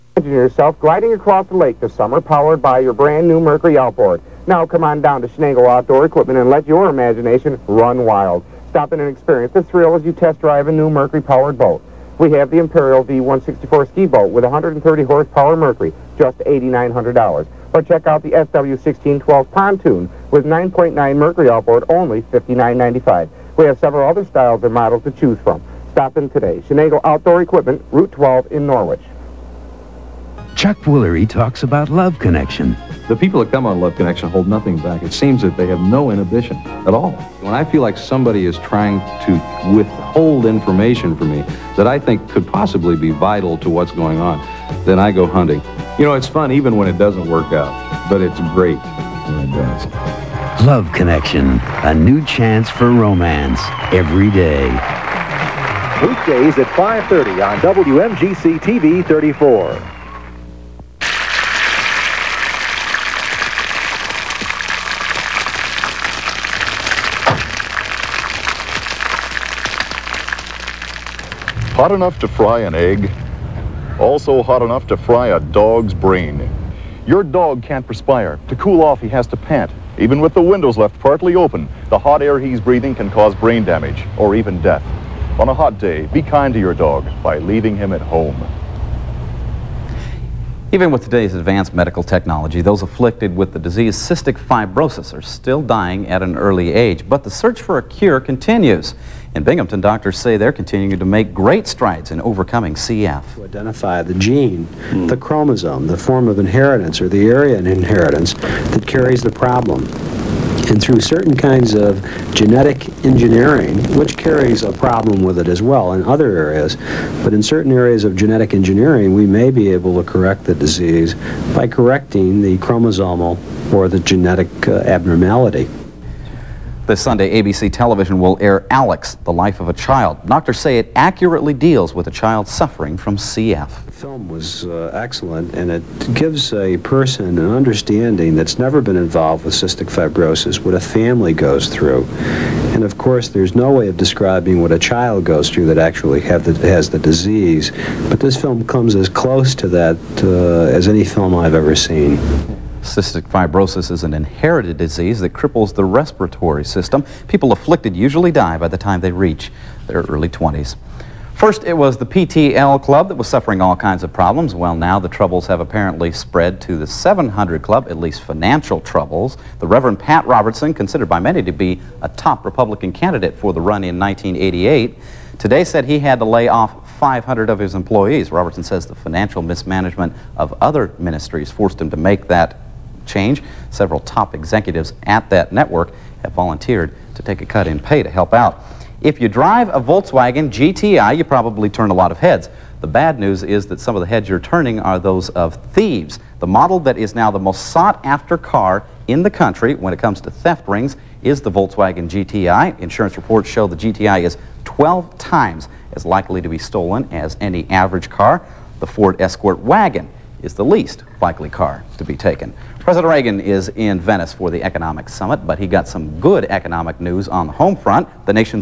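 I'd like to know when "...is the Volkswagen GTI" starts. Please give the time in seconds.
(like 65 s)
201 s.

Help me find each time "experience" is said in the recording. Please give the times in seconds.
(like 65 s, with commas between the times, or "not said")
9 s.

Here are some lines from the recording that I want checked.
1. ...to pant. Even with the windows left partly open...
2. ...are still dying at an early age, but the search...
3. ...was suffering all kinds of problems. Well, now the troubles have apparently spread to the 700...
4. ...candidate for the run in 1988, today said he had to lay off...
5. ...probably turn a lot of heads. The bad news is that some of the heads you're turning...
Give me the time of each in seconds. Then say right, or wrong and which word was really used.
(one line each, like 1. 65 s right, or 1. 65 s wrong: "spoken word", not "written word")
1. 79 s right
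2. 95 s right
3. 163 s right
4. 172 s right
5. 191 s right.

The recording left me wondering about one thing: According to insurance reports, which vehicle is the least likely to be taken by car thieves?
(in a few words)
Ford Escort wagon.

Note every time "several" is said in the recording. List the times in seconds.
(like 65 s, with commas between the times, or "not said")
23 s, 183 s.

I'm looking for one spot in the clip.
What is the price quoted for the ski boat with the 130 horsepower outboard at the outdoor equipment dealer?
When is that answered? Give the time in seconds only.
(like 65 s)
16 s.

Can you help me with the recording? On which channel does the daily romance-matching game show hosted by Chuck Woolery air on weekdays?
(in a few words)
WMGC TV 34.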